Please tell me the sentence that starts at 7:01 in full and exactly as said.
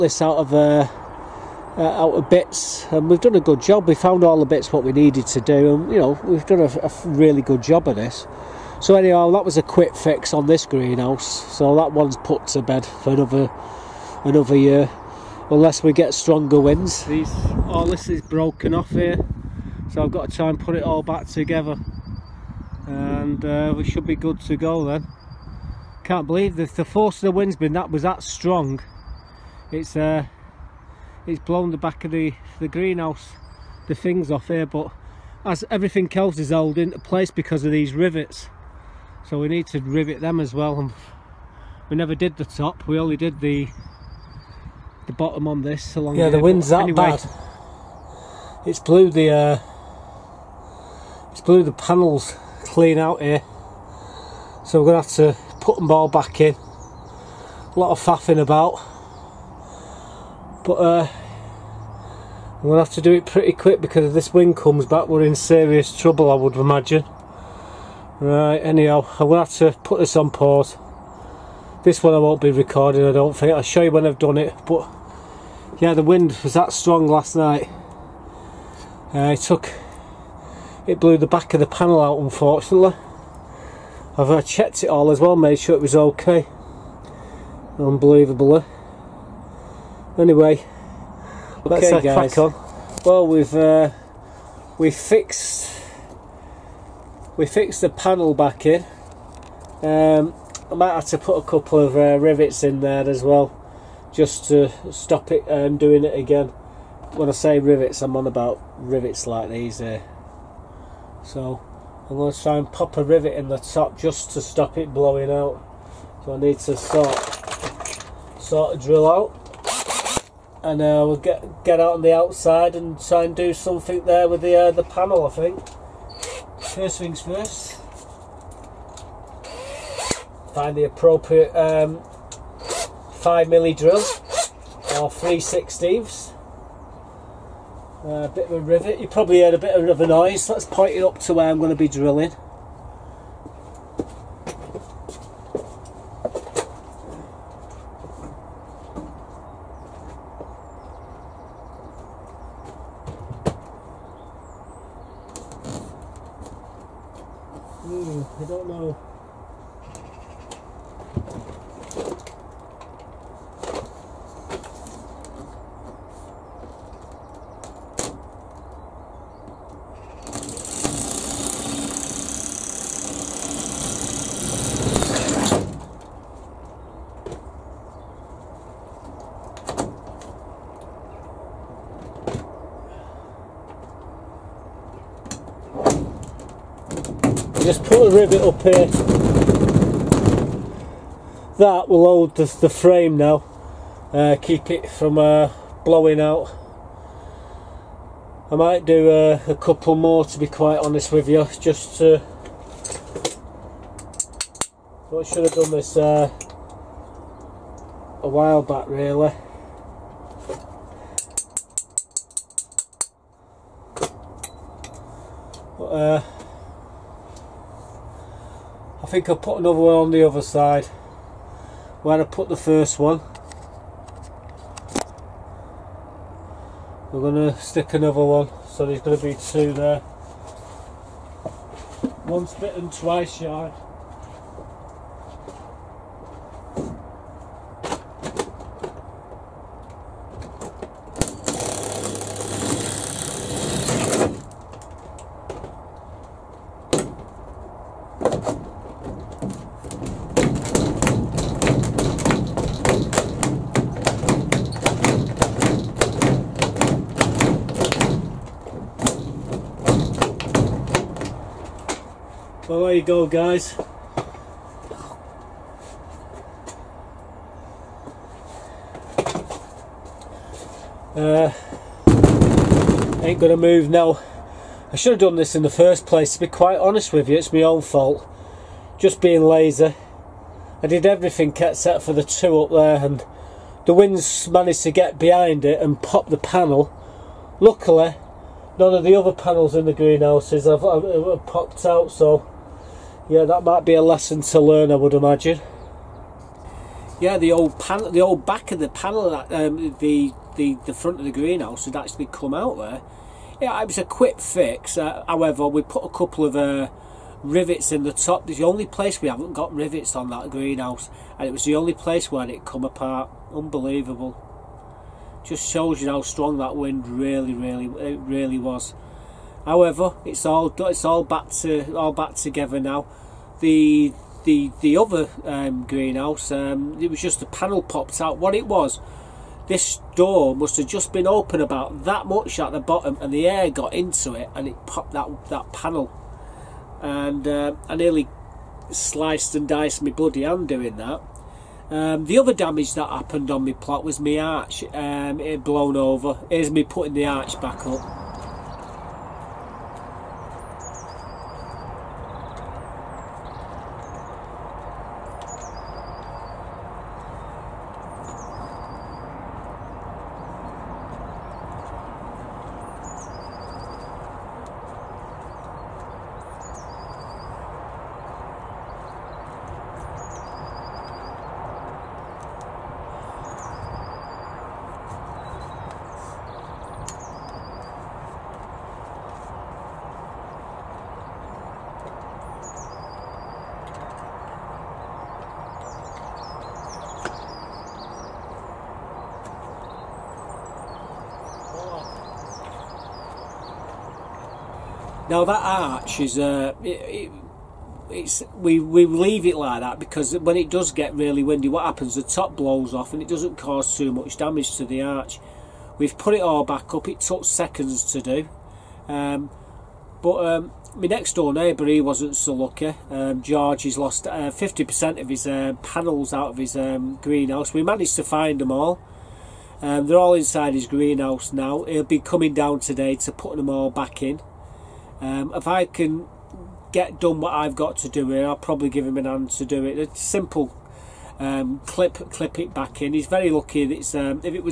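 He'll be coming down today to put them all back in.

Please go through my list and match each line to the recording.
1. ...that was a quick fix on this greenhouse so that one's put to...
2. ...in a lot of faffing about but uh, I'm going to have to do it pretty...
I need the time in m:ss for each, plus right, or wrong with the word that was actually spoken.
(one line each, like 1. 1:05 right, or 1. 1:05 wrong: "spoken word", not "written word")
1. 0:09 right
2. 0:56 right.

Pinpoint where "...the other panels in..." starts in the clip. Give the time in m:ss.
4:49.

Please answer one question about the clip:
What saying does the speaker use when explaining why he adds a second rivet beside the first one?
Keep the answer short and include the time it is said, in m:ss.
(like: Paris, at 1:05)
Once bitten twice shy, at 3:52.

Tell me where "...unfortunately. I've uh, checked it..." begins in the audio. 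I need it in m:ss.
1:22.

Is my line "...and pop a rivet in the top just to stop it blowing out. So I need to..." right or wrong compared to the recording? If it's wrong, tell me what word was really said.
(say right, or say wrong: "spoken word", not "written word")
right.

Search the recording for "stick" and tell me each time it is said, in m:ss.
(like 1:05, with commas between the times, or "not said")
3:47.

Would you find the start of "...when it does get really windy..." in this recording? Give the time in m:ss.
6:40.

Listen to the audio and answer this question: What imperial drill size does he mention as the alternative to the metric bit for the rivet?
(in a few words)
3/16.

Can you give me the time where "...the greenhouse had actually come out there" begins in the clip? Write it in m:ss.
5:01.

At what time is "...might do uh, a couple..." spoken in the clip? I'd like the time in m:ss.
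3:18.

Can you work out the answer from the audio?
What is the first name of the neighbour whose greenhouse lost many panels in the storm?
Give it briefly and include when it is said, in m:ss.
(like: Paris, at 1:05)
George, at 6:53.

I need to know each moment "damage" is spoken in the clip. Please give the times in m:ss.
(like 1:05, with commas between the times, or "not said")
5:42, 6:44.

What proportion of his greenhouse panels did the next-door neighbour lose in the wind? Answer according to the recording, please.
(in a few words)
50%.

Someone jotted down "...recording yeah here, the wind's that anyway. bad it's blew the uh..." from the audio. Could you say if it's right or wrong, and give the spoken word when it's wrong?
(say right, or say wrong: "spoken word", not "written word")
wrong: "along", not "recording".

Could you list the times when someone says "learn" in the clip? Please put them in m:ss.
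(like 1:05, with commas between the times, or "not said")
4:54.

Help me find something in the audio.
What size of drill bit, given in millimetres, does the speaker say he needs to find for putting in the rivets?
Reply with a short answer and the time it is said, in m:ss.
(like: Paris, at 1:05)
5 mm, at 2:13.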